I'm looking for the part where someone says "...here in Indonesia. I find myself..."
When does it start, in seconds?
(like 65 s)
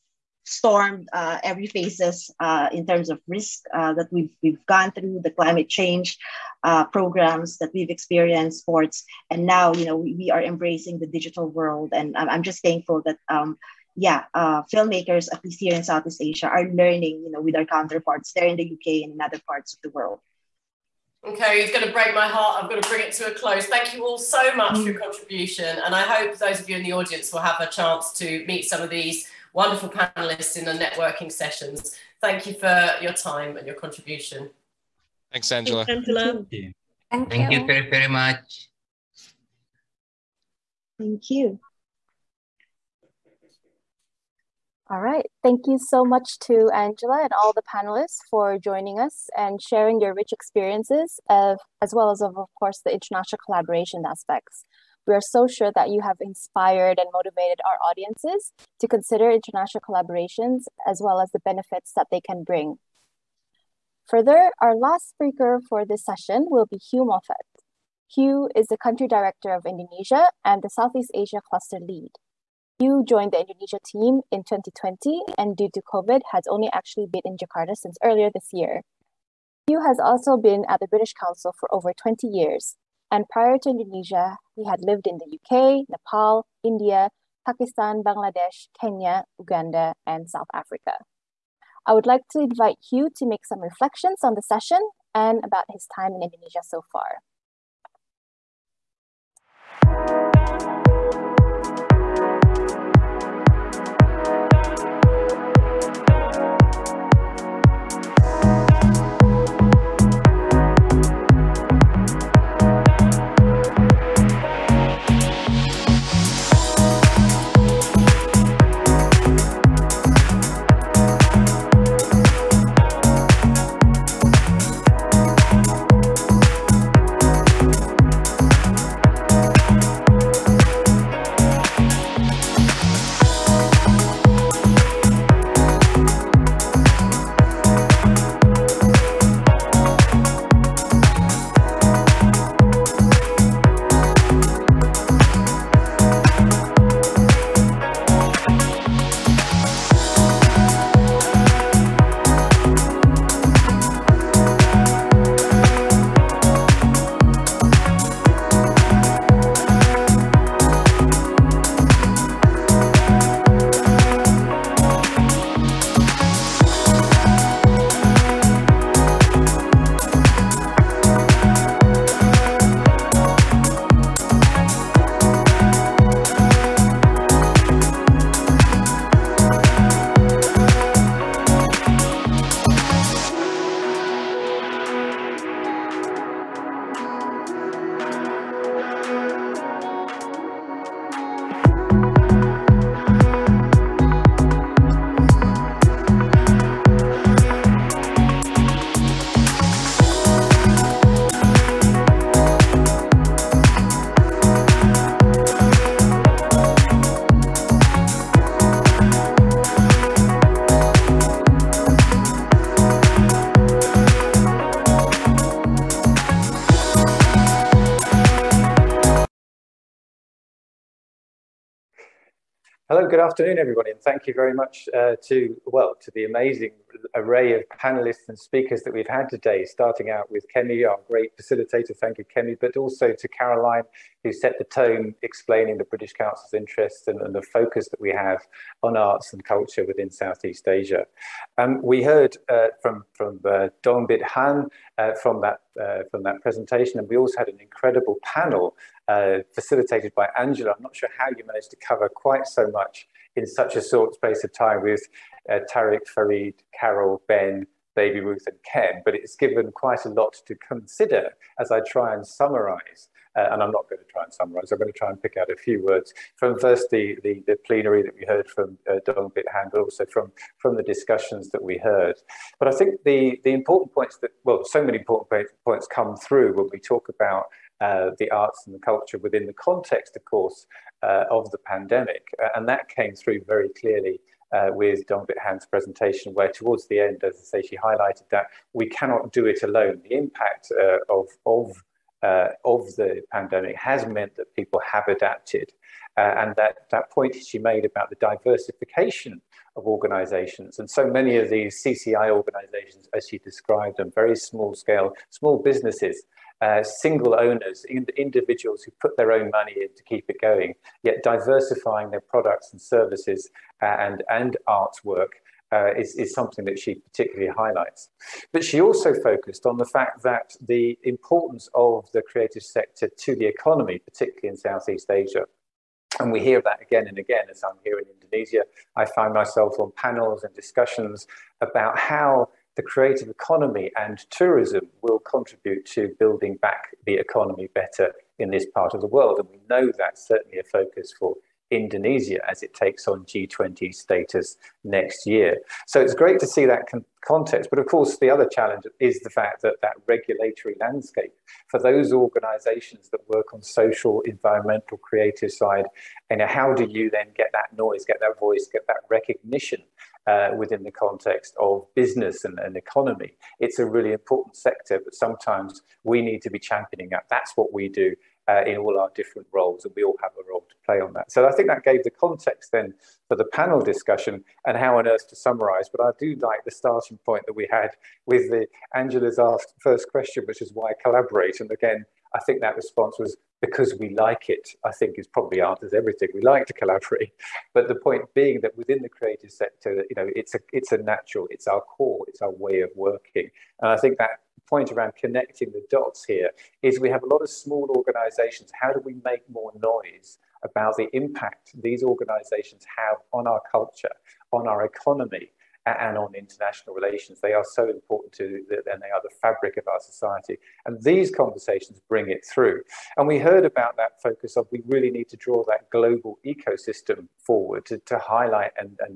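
327 s.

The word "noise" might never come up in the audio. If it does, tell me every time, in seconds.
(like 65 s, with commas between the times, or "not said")
357 s, 399 s.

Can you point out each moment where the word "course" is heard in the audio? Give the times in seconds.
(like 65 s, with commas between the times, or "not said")
52 s, 280 s, 347 s.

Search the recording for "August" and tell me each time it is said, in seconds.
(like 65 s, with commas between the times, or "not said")
not said.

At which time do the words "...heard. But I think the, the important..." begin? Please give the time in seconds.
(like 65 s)
271 s.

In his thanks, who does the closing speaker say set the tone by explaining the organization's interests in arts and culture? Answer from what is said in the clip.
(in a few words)
Caroline.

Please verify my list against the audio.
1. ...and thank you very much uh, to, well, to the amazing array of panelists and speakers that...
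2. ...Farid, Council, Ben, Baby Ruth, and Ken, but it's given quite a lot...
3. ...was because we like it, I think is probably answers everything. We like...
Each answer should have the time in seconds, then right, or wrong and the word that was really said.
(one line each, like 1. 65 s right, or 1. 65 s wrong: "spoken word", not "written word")
1. 223 s right
2. 256 s wrong: "Carol", not "Council"
3. 383 s right.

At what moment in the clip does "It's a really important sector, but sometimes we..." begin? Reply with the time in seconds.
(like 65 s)
363 s.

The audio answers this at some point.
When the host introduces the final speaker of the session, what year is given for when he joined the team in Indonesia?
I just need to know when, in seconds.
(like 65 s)
74 s.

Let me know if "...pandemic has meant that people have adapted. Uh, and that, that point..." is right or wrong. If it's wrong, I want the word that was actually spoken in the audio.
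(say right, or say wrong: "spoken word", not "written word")
right.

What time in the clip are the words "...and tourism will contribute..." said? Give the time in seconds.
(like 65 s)
333 s.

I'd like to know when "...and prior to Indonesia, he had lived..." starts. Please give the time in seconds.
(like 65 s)
83 s.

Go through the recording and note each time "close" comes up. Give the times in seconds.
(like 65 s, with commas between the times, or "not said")
23 s.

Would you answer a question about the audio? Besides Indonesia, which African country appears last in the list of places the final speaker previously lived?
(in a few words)
South Africa.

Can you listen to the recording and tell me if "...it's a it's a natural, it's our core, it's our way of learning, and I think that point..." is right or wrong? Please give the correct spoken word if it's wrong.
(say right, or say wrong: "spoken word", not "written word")
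wrong: "working", not "learning".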